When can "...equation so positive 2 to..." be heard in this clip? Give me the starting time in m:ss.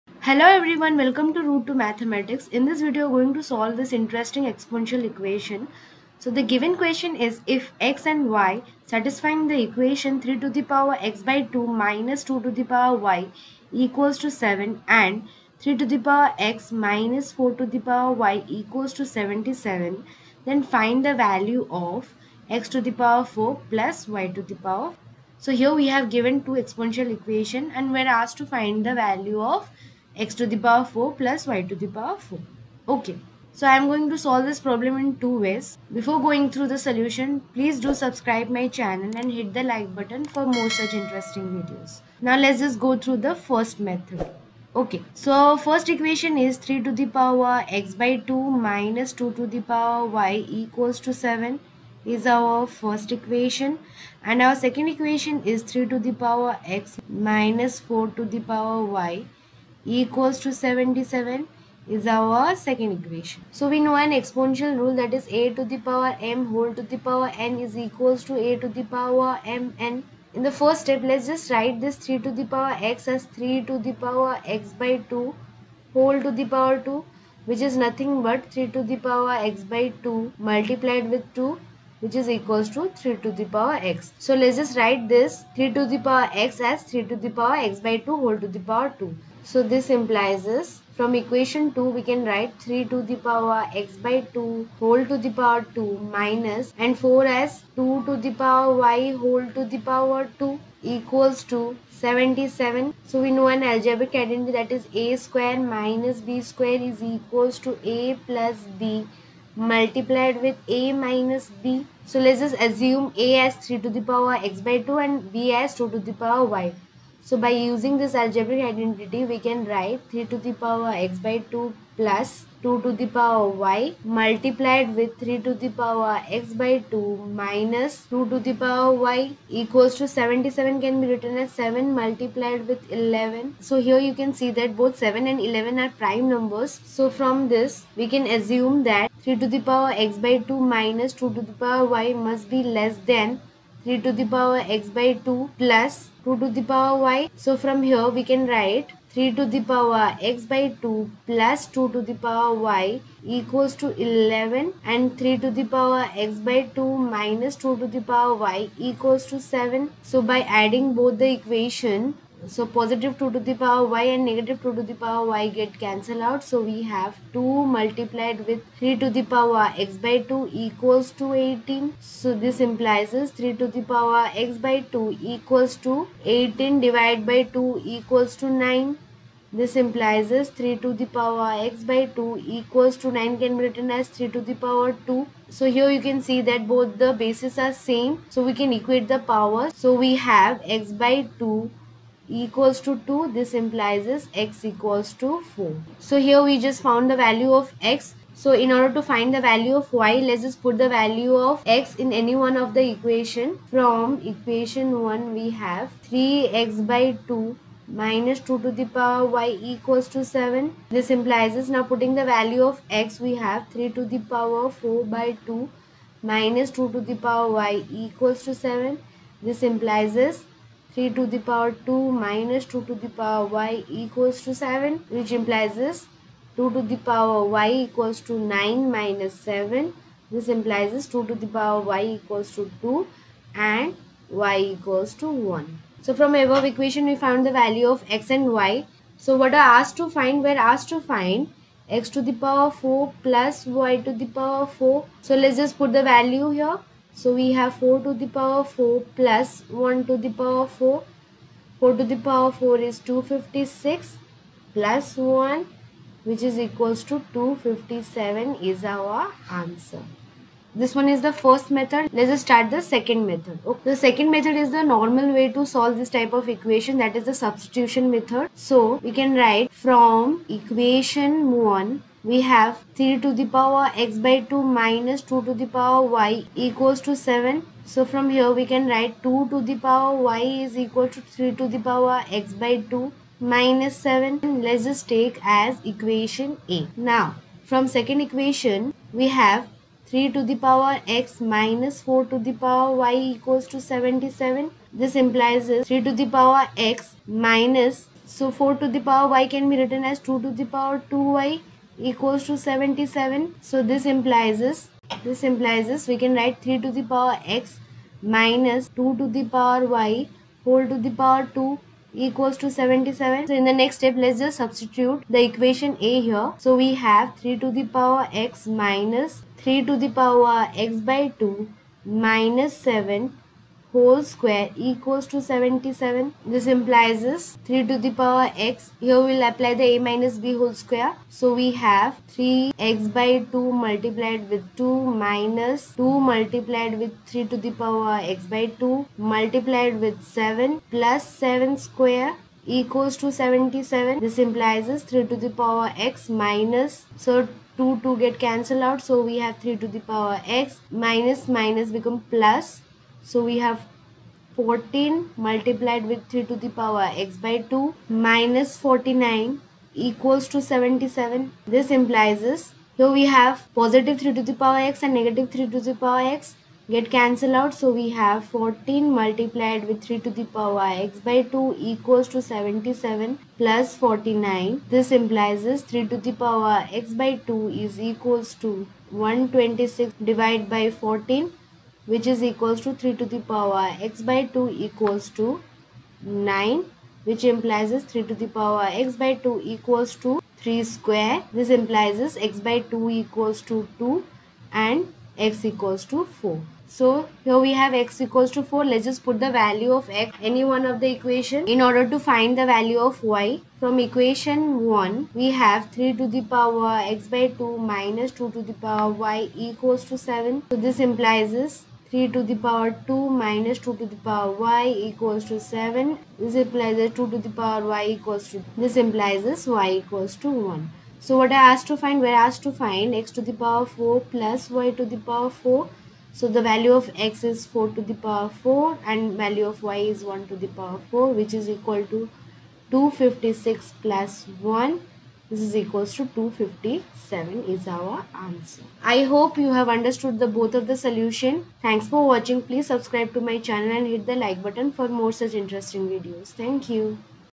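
2:41.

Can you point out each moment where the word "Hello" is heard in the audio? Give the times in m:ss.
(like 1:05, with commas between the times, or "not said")
0:00.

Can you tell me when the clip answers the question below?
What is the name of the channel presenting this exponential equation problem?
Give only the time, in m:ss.
0:01.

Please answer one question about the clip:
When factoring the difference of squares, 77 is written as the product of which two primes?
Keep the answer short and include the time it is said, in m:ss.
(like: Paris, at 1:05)
7 multiplied with 11, at 2:11.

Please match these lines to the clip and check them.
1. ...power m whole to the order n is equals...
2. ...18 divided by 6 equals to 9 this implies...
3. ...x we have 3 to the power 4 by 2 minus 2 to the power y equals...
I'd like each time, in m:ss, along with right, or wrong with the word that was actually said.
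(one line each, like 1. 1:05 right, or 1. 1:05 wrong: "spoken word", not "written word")
1. 1:05 wrong: "power", not "order"
2. 2:56 wrong: "2", not "6"
3. 3:33 right.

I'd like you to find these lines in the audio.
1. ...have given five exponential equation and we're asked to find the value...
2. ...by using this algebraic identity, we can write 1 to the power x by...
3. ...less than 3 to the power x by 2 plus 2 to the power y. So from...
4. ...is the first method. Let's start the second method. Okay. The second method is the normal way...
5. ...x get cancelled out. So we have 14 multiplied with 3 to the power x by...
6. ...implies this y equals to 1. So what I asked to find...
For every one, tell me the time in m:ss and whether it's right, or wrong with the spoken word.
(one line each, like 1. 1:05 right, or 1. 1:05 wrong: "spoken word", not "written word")
1. 0:25 wrong: "two", not "five"
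2. 1:57 wrong: "3", not "1"
3. 2:22 right
4. 4:21 right
5. 6:06 right
6. 6:58 right.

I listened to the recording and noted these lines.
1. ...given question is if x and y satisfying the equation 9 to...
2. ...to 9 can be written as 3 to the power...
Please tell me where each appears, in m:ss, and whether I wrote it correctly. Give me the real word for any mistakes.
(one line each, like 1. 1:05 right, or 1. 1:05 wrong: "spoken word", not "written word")
1. 0:06 wrong: "3", not "9"
2. 3:02 right.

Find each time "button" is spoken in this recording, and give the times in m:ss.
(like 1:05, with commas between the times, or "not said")
0:39, 7:24.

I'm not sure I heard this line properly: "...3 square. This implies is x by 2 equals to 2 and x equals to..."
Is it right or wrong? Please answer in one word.
right.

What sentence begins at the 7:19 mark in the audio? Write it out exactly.
I hope you have understood the both of the solution.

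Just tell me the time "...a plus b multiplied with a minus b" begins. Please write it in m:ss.
1:47.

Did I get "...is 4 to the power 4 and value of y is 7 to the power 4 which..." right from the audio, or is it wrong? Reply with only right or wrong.
wrong.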